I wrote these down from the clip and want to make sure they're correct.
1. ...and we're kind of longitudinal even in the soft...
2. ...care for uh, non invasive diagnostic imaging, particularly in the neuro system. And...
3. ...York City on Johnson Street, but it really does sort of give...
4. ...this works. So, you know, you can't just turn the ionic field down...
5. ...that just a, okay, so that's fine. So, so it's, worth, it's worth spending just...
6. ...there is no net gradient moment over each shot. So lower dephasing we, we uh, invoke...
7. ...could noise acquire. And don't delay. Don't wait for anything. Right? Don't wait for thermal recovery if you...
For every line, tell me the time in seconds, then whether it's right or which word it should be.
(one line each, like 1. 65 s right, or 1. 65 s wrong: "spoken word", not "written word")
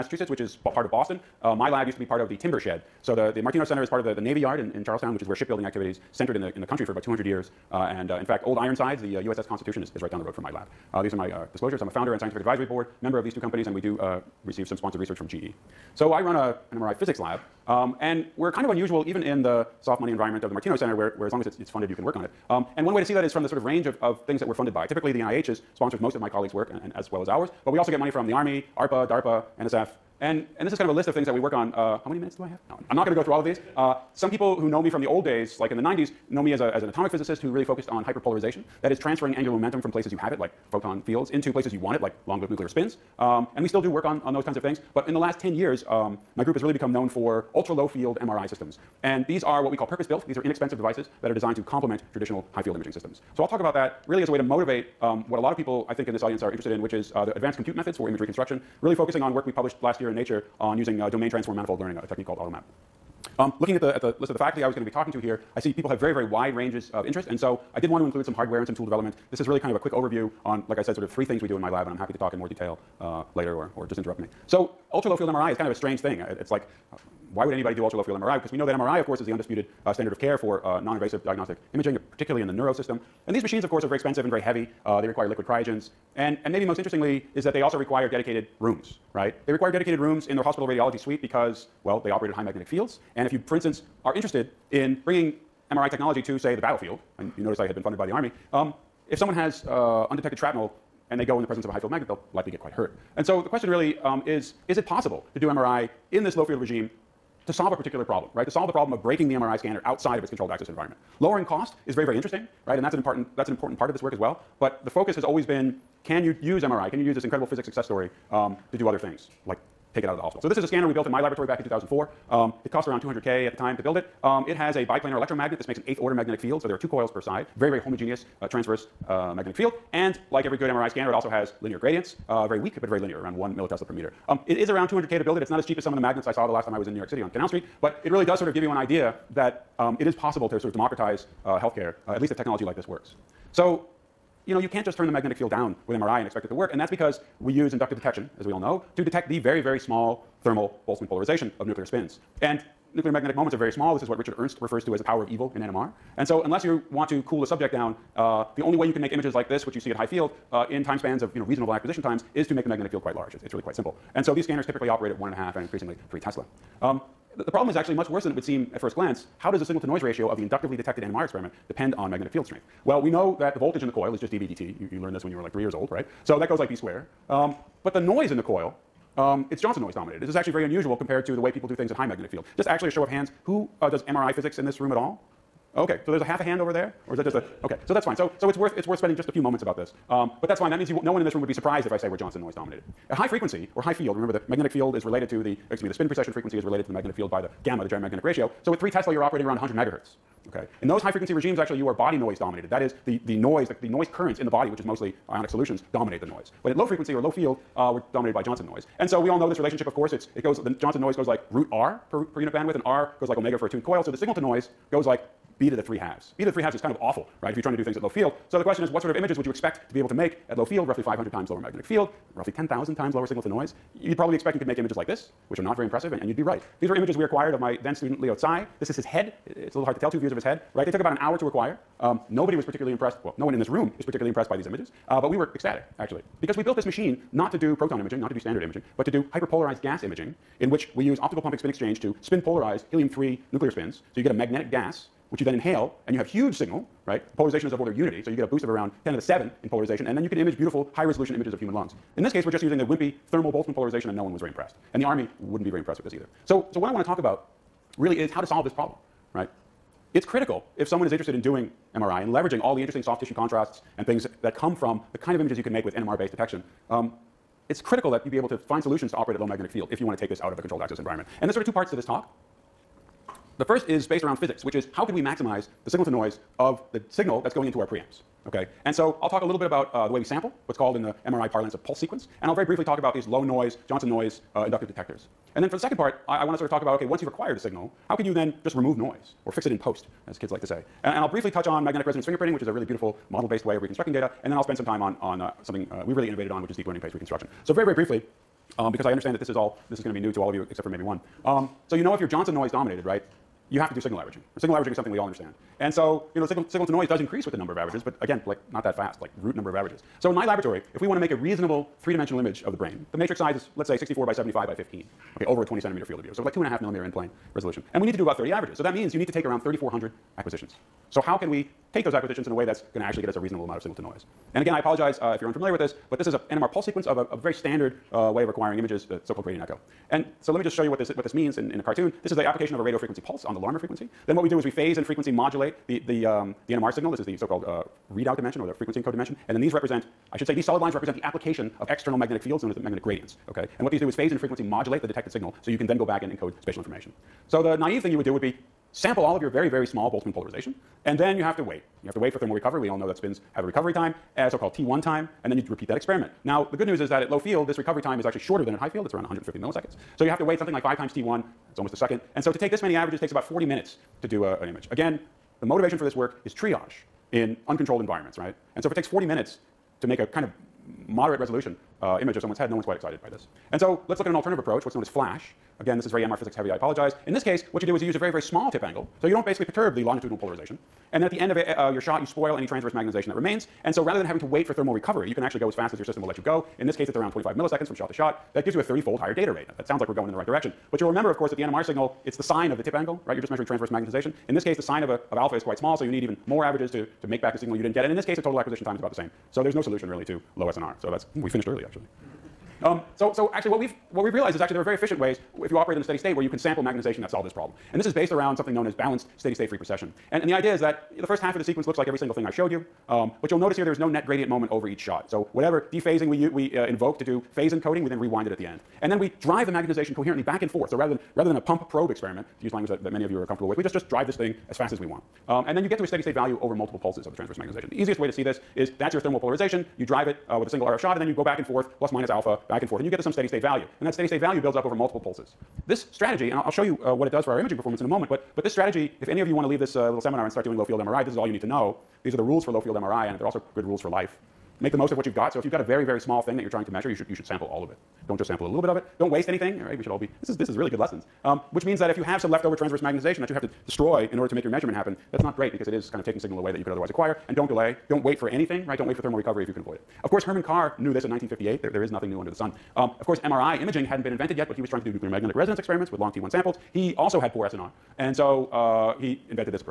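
1. 18 s wrong: "unusual", not "longitudinal"
2. 80 s right
3. 136 s wrong: "Canal", not "Johnson"
4. 142 s wrong: "magnetic", not "ionic"
5. 187 s right
6. 413 s wrong: "whatever", not "lower"
7. 456 s wrong: "otherwise", not "noise".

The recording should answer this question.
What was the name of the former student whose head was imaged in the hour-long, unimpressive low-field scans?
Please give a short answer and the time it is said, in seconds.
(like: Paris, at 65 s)
Leo Tsai, at 228 s.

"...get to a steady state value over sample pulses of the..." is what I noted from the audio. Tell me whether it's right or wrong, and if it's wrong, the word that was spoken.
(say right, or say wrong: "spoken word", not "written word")
wrong: "multiple", not "sample".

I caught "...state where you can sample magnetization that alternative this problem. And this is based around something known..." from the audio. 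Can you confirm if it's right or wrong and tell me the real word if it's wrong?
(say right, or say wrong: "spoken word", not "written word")
wrong: "solve", not "alternative".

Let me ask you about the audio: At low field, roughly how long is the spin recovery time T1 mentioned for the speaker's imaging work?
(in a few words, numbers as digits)
150 milliseconds.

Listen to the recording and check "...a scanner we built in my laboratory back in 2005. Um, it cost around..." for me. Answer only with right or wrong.
wrong.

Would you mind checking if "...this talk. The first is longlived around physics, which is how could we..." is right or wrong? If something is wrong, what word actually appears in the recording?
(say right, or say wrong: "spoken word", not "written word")
wrong: "based", not "longlived".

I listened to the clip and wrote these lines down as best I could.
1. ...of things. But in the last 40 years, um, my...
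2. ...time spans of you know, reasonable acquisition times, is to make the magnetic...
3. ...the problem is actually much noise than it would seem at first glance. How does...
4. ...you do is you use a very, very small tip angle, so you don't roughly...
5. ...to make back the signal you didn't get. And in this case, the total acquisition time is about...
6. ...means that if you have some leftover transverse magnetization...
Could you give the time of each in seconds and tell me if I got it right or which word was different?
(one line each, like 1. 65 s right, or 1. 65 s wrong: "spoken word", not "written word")
1. 44 s wrong: "10", not "40"
2. 160 s right
3. 167 s wrong: "worse", not "noise"
4. 377 s wrong: "basically", not "roughly"
5. 397 s right
6. 451 s right.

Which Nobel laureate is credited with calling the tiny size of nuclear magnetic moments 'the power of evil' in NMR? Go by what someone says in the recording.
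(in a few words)
Richard Ernst.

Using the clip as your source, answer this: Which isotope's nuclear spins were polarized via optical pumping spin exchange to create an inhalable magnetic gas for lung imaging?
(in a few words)
helium-3.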